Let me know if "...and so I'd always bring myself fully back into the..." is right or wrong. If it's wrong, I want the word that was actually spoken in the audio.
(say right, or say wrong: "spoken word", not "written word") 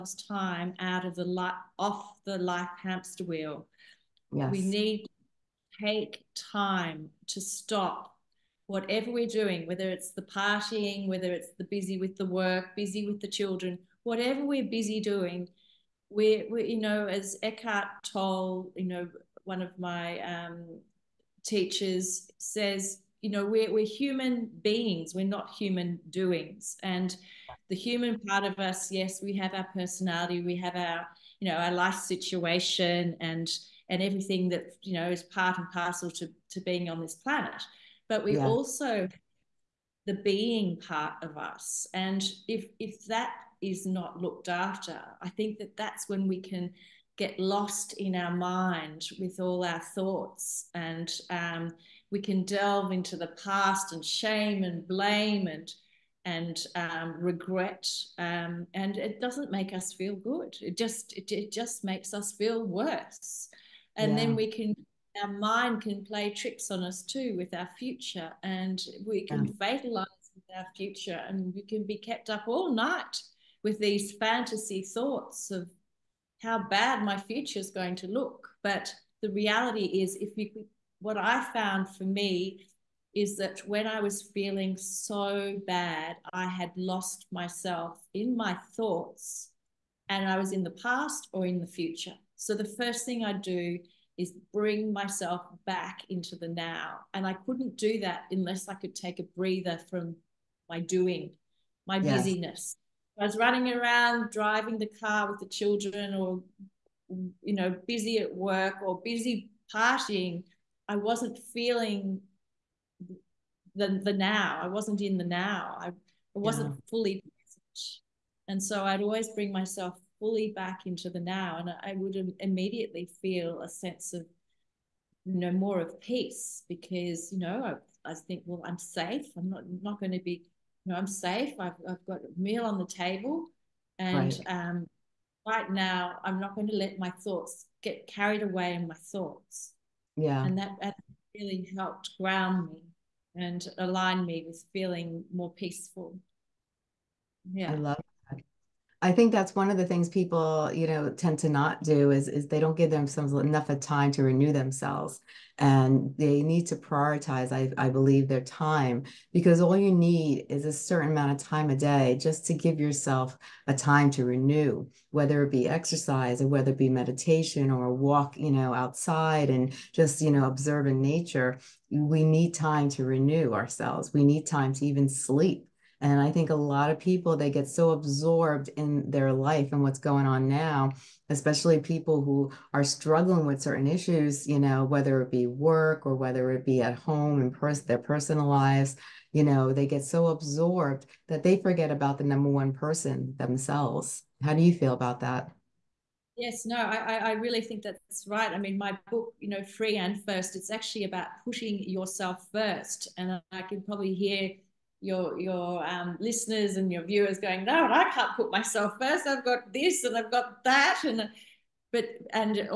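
right.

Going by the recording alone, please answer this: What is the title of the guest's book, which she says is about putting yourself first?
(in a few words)
Free and First.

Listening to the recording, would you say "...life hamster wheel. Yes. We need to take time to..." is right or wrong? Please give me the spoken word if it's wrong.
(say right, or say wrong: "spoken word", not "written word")
right.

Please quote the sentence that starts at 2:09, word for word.
I'm not not going to be you know, I'm safe.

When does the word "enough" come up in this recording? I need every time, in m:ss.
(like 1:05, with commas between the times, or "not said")
2:33.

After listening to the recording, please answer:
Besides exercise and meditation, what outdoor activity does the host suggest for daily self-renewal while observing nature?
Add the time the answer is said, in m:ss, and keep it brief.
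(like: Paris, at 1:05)
a walk, at 2:47.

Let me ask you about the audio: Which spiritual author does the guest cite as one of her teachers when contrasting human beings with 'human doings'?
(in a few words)
Eckhart Tolle.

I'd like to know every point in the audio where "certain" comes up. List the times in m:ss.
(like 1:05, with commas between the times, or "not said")
2:40, 3:03.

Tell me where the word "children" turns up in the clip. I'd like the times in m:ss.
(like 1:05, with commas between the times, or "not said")
0:13, 1:45.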